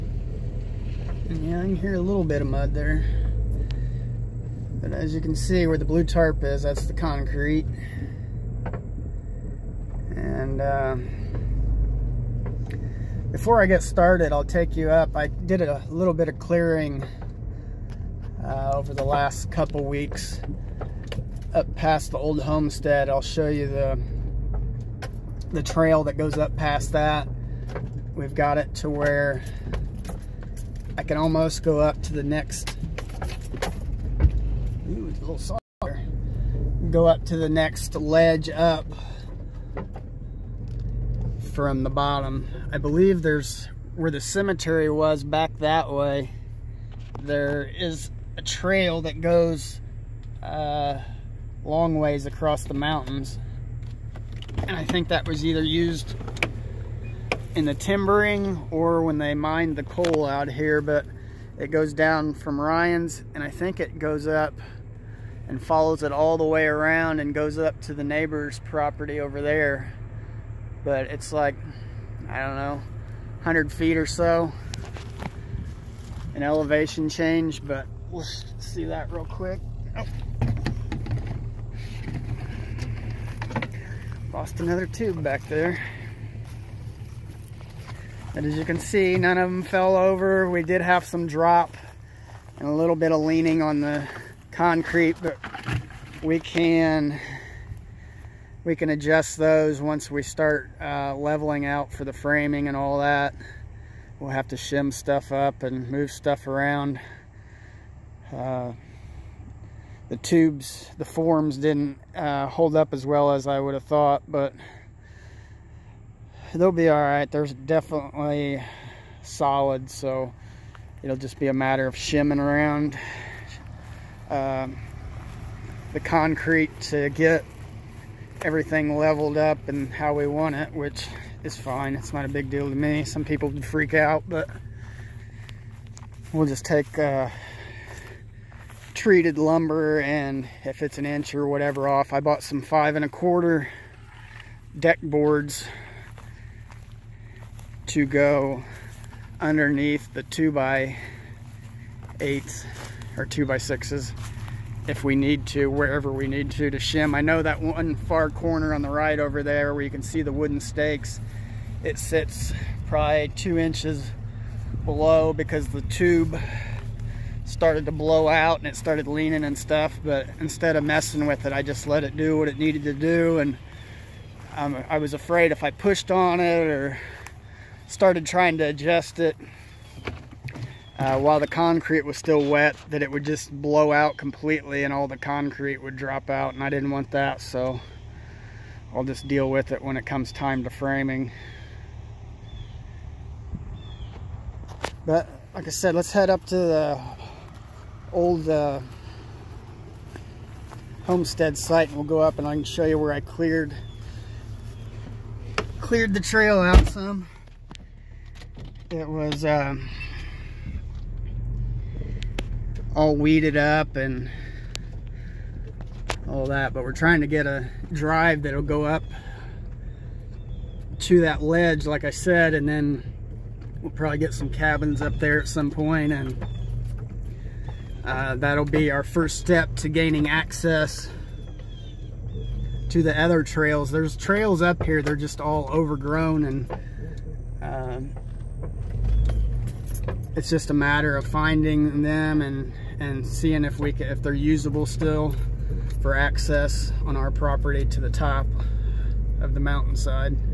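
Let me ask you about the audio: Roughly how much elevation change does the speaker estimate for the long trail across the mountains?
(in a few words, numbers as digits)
100 feet.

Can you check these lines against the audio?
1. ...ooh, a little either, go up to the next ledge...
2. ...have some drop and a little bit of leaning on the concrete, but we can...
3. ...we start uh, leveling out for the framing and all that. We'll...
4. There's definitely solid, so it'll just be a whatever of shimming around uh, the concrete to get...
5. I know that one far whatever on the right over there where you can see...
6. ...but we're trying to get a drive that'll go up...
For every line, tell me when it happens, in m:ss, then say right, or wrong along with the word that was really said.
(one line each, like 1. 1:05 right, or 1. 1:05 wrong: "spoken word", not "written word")
1. 0:34 wrong: "softer", not "either"
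2. 1:30 right
3. 1:40 right
4. 1:57 wrong: "matter", not "whatever"
5. 2:37 wrong: "corner", not "whatever"
6. 3:36 right.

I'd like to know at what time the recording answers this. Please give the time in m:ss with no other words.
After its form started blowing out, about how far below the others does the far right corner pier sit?
2:43.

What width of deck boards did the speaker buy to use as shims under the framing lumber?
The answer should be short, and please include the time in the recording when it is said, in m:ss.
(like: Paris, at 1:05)
5 1/4, at 2:22.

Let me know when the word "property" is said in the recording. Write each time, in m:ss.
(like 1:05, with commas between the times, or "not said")
1:08, 4:07.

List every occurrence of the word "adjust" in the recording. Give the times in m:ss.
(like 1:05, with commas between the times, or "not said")
1:38, 2:58.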